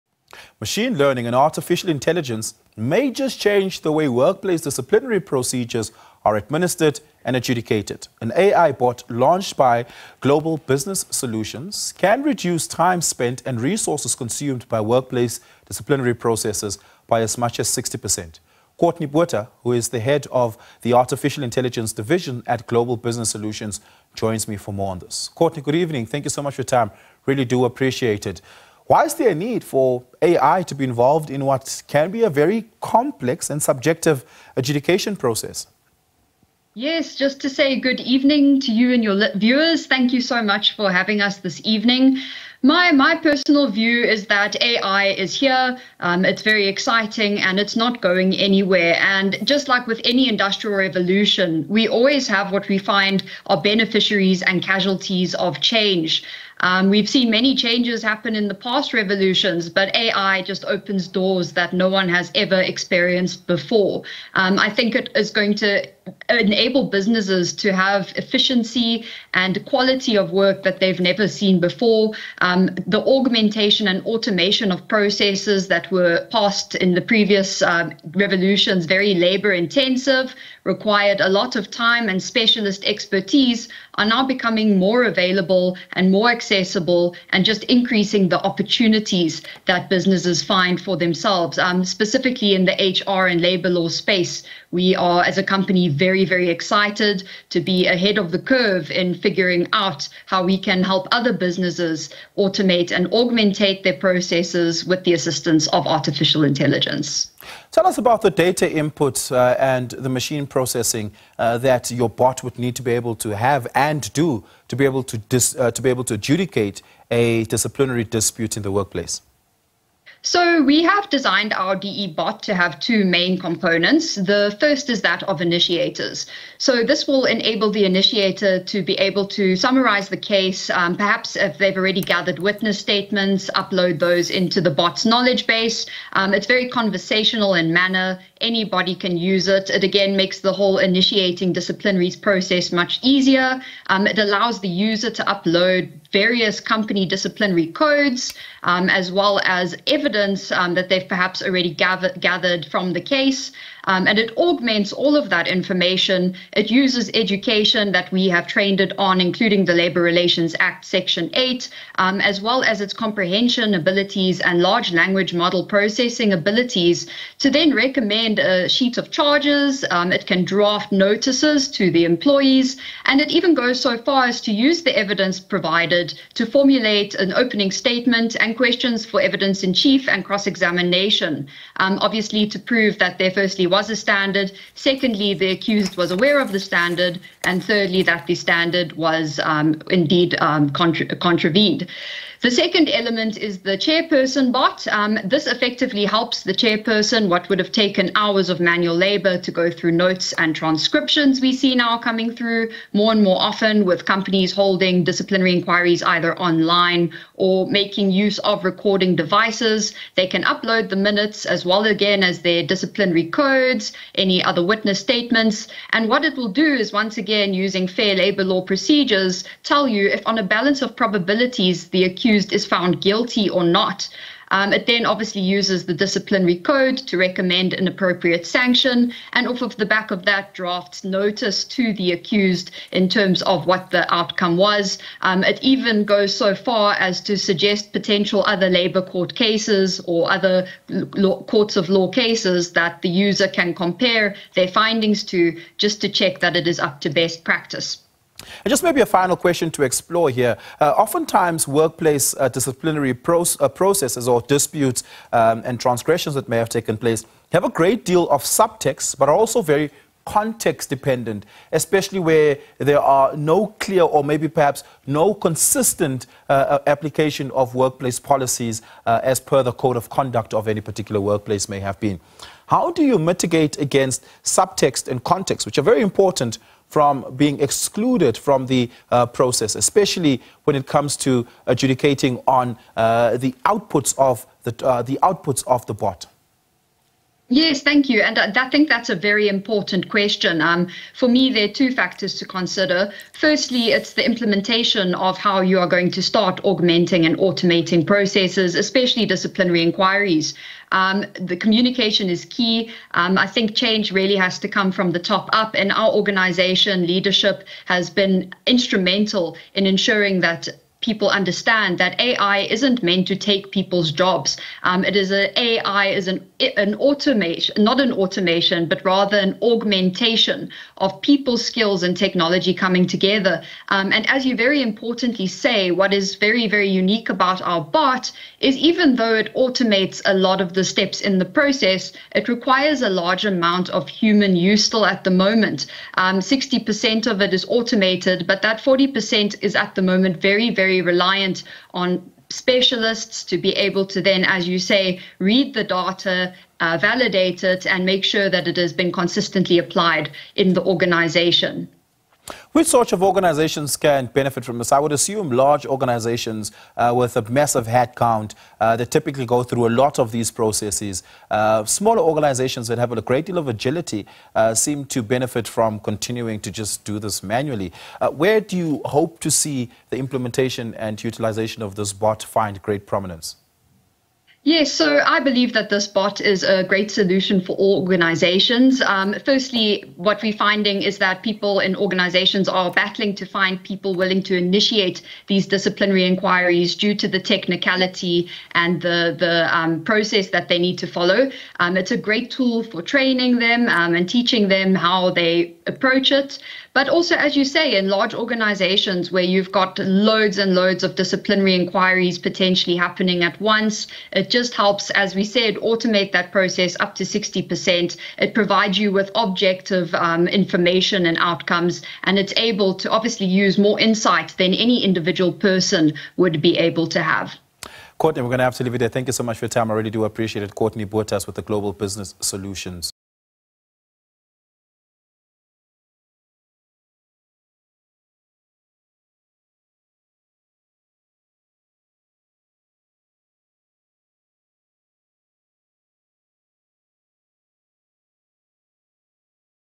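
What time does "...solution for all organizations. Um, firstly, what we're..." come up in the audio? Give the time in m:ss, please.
6:17.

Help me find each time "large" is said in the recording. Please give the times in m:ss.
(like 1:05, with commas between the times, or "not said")
2:44, 5:33, 5:55, 6:38.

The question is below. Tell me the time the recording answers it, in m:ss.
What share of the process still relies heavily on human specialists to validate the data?
5:38.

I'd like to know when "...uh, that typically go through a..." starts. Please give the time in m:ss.
5:58.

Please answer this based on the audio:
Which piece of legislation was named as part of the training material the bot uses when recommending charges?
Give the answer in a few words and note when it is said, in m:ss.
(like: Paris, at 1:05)
Labor Relations Act, at 2:39.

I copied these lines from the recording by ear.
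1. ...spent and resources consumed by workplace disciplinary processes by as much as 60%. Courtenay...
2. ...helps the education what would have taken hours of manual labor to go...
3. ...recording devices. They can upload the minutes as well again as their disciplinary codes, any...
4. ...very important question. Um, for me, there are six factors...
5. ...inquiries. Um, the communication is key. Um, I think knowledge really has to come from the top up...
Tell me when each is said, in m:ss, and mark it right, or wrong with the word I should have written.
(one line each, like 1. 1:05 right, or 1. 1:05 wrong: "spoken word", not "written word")
1. 0:13 right
2. 3:16 wrong: "chairperson", not "education"
3. 3:28 right
4. 4:49 wrong: "two", not "six"
5. 4:59 wrong: "change", not "knowledge".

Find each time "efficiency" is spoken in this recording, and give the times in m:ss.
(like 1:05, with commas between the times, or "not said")
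1:08.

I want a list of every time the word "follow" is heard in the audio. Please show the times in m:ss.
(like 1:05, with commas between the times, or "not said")
6:31.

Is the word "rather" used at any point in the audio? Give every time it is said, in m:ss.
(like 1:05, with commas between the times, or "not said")
5:19.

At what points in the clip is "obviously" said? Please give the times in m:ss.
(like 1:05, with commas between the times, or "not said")
3:02, 3:45, 6:53.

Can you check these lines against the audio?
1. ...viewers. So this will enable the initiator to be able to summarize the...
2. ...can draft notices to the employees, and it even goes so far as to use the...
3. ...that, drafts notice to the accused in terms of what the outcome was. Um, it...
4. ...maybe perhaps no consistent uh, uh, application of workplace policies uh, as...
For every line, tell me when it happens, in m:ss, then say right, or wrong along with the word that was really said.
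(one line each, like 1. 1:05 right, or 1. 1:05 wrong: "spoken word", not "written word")
1. 2:05 wrong: "initiators", not "viewers"
2. 2:50 right
3. 3:50 right
4. 4:24 right.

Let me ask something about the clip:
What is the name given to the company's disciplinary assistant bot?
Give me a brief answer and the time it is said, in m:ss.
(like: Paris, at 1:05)
DE bot, at 2:01.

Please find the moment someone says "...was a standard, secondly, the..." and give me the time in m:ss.
3:03.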